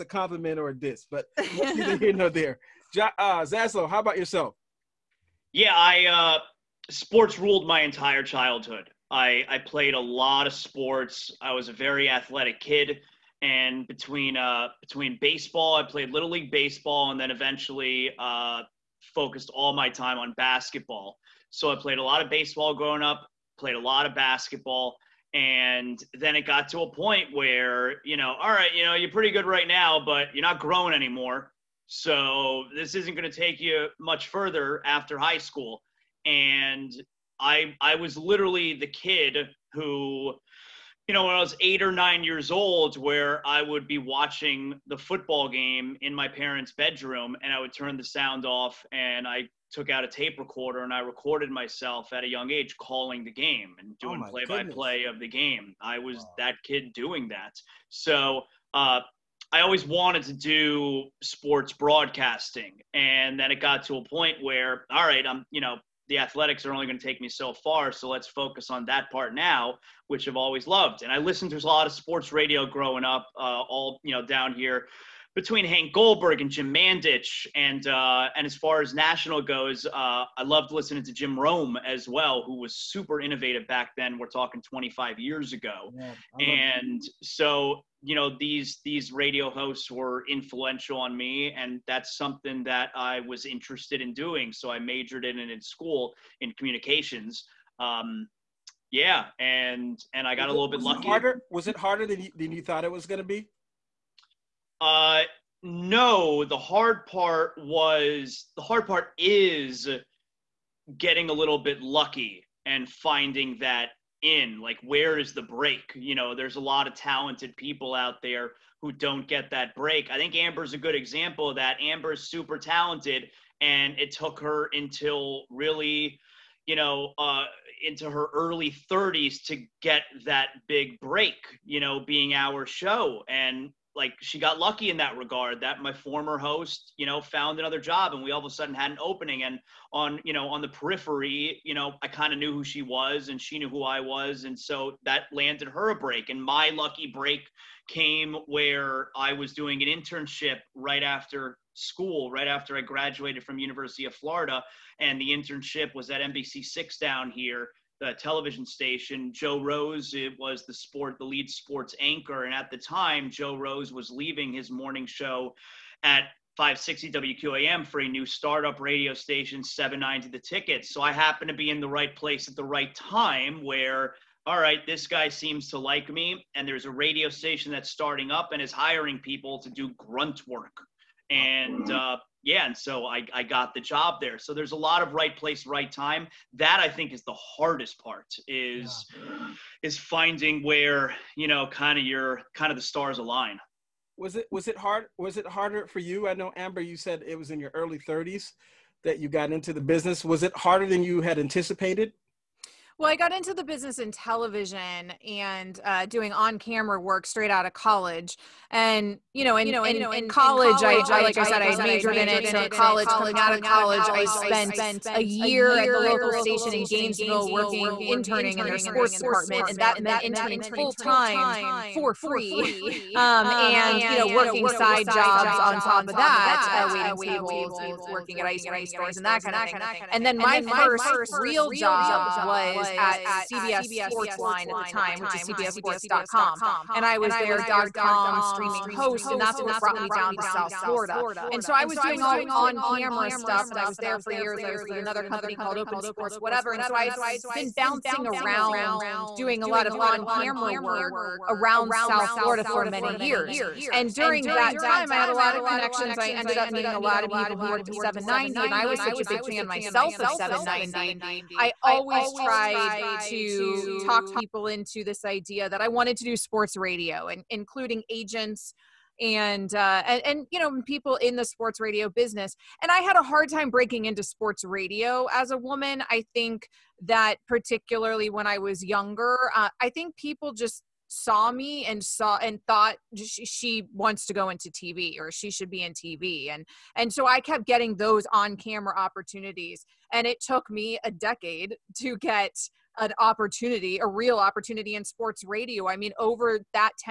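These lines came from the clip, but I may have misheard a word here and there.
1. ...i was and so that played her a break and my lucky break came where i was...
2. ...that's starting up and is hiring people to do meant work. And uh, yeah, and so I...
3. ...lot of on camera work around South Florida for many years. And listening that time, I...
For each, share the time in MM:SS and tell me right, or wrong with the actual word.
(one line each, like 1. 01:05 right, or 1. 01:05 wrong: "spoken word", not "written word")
1. 02:23 wrong: "landed", not "played"
2. 02:57 wrong: "grunt", not "meant"
3. 04:09 wrong: "during", not "listening".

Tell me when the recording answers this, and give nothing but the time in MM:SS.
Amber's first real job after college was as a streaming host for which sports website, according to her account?
03:55.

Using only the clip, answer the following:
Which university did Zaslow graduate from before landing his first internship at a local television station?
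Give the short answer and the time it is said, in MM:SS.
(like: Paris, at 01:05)
University of Florida, at 02:33.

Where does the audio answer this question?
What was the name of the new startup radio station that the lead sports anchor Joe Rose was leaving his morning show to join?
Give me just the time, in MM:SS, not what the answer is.
02:49.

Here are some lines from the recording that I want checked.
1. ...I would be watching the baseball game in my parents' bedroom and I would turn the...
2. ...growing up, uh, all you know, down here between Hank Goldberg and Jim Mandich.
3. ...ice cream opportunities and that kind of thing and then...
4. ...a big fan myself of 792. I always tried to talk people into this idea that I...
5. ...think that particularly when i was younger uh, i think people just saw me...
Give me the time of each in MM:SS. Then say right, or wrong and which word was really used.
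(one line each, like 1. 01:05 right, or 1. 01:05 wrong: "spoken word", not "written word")
1. 00:43 wrong: "football", not "baseball"
2. 01:12 right
3. 03:48 wrong: "stores", not "opportunities"
4. 04:19 wrong: "790", not "792"
5. 04:36 right.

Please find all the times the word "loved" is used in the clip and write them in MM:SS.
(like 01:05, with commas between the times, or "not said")
01:10, 01:20.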